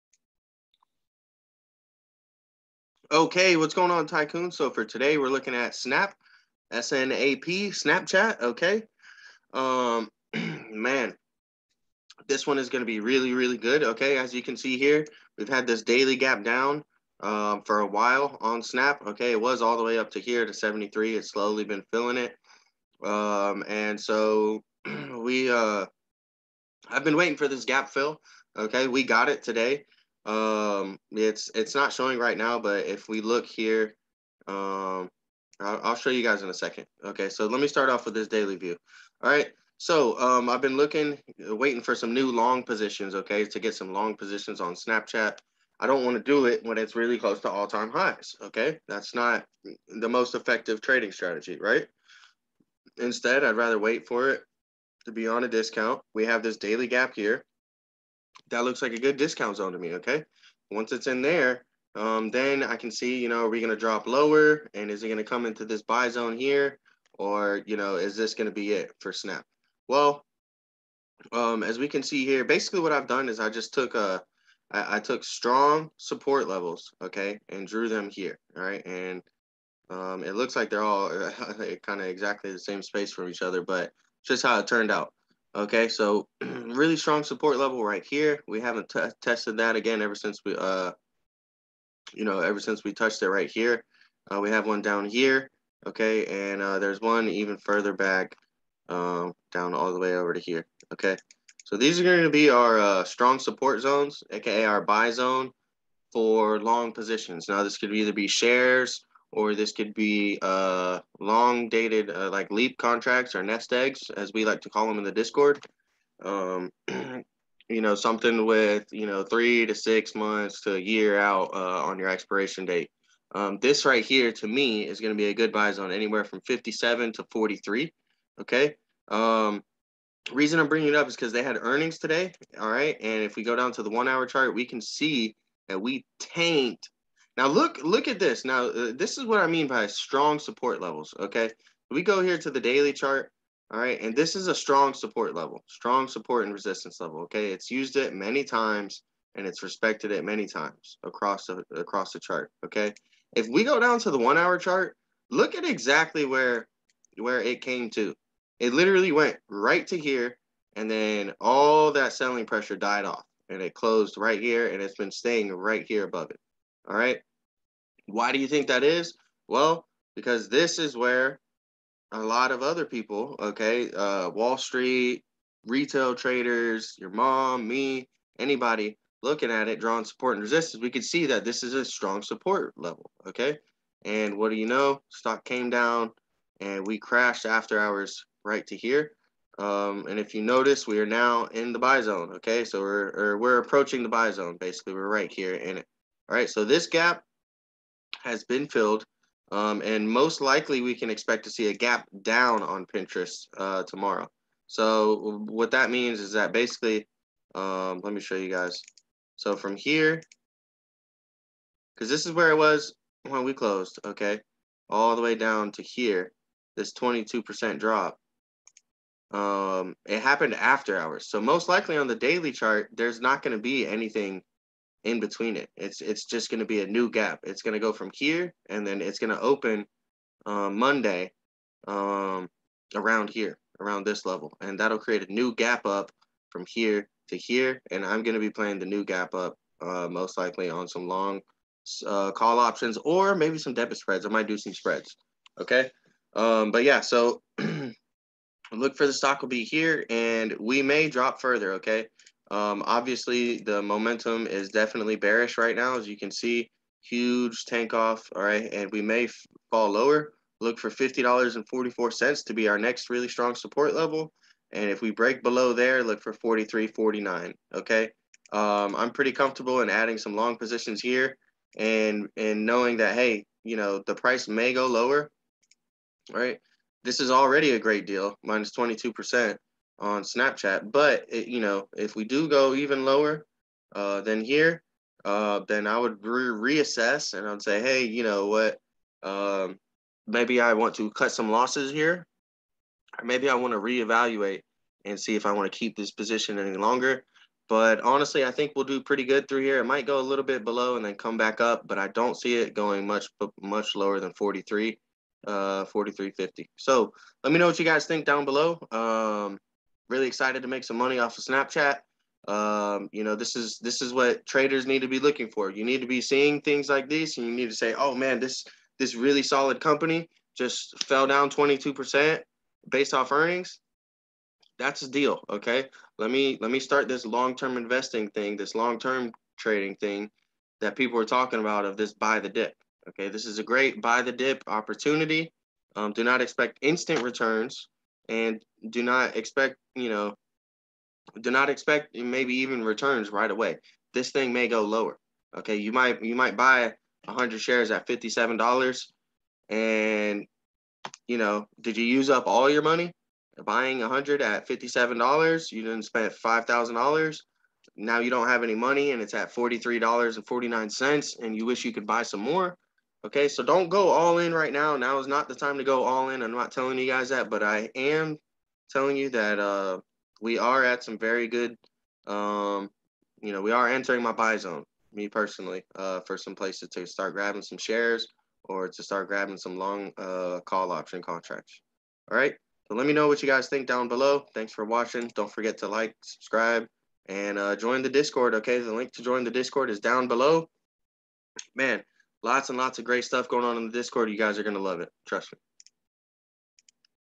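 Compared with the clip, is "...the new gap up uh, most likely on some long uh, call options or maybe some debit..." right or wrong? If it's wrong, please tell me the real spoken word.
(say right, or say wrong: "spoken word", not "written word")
right.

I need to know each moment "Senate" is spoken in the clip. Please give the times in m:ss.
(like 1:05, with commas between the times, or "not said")
not said.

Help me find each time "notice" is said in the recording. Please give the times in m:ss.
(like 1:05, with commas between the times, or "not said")
3:10.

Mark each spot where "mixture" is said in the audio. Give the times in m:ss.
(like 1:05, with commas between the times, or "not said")
not said.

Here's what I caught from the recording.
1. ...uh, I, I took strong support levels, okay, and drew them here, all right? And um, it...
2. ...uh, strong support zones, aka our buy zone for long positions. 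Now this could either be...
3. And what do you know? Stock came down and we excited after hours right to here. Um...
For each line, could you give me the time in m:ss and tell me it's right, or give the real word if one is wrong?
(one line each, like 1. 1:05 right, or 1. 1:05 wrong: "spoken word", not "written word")
1. 1:13 right
2. 1:42 right
3. 3:04 wrong: "crashed", not "excited".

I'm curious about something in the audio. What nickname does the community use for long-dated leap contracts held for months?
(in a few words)
nest eggs.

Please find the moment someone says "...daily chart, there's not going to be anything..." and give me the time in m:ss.
3:42.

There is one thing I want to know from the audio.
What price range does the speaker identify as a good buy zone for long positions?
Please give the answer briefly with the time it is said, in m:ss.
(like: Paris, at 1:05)
57 to 43, at 2:06.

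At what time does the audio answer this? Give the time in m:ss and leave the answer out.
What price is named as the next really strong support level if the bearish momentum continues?
4:20.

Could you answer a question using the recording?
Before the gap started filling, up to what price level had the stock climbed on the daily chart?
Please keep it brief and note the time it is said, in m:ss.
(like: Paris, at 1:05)
73, at 0:20.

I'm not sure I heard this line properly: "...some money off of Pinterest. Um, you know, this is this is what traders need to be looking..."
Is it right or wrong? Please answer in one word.
wrong.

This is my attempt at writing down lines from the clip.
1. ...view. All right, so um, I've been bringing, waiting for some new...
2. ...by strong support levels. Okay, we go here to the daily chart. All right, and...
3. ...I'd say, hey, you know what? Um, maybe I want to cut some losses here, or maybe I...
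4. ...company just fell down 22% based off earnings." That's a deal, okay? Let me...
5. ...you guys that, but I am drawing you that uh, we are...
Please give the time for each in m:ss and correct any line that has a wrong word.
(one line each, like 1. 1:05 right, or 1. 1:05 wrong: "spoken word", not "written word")
1. 0:38 wrong: "looking", not "bringing"
2. 2:19 right
3. 4:47 right
4. 5:19 right
5. 6:06 wrong: "telling", not "drawing".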